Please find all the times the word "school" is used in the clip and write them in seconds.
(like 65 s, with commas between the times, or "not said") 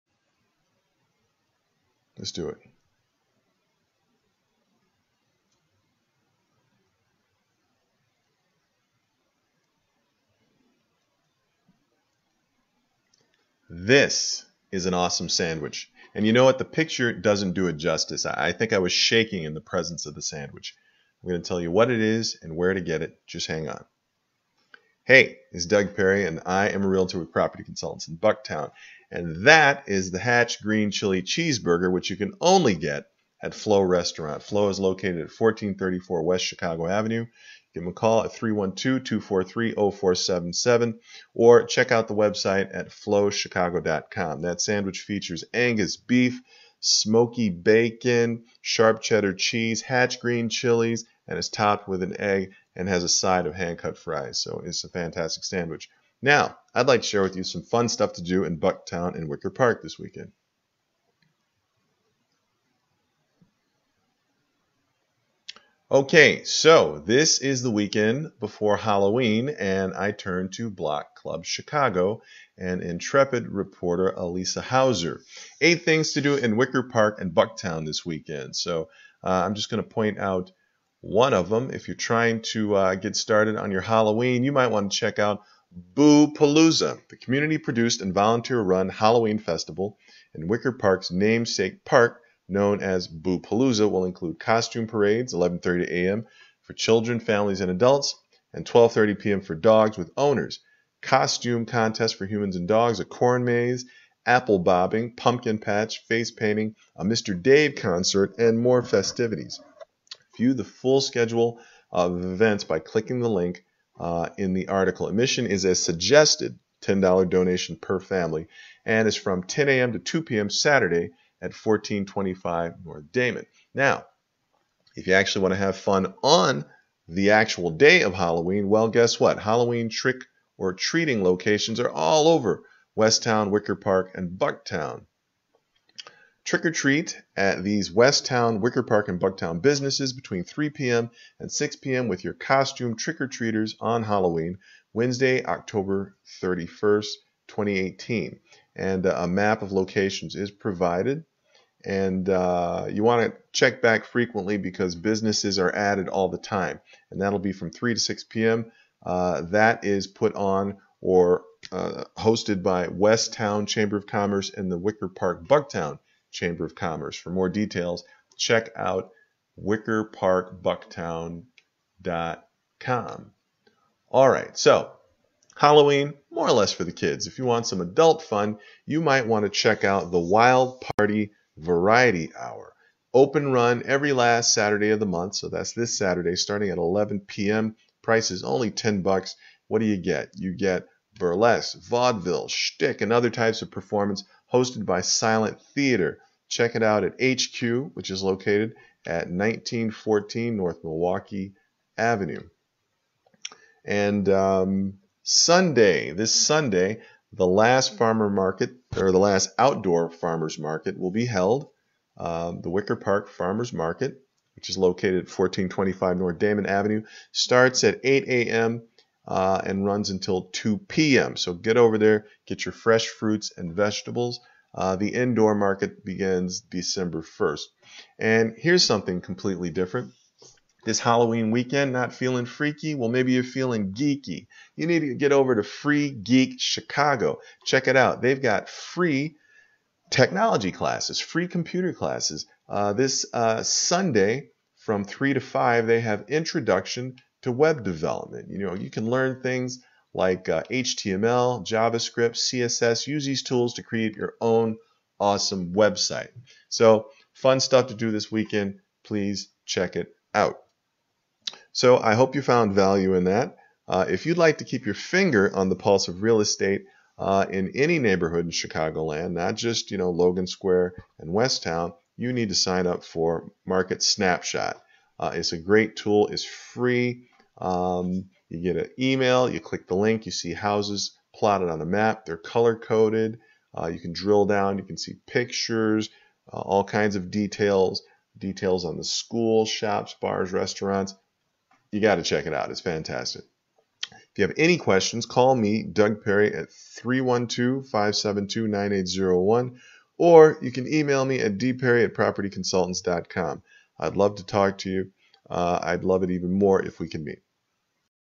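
289 s.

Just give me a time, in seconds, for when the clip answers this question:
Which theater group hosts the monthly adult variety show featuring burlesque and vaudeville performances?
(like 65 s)
195 s.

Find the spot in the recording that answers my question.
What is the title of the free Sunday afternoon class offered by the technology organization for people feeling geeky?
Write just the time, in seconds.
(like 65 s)
246 s.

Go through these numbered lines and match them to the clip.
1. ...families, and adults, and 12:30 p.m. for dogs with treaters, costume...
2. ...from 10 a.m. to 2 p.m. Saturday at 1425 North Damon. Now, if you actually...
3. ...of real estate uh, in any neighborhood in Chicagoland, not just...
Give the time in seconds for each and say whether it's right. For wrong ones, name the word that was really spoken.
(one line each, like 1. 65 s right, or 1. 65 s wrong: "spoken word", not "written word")
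1. 97 s wrong: "owners", not "treaters"
2. 119 s right
3. 266 s right.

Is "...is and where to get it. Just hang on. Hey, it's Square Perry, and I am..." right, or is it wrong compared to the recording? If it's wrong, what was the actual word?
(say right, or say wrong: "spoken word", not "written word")
wrong: "Doug", not "Square".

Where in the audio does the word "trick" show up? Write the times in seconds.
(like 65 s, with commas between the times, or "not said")
129 s, 136 s, 142 s.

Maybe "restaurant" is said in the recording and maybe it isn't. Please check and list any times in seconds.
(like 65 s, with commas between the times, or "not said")
33 s, 290 s.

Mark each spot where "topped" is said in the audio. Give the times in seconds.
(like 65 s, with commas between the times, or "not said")
51 s.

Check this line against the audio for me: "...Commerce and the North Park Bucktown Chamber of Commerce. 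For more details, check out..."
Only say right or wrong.
wrong.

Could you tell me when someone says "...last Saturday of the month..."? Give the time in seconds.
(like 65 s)
184 s.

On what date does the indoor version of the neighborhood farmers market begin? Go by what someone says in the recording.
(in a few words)
December 1st.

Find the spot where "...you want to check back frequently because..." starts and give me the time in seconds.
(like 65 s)
152 s.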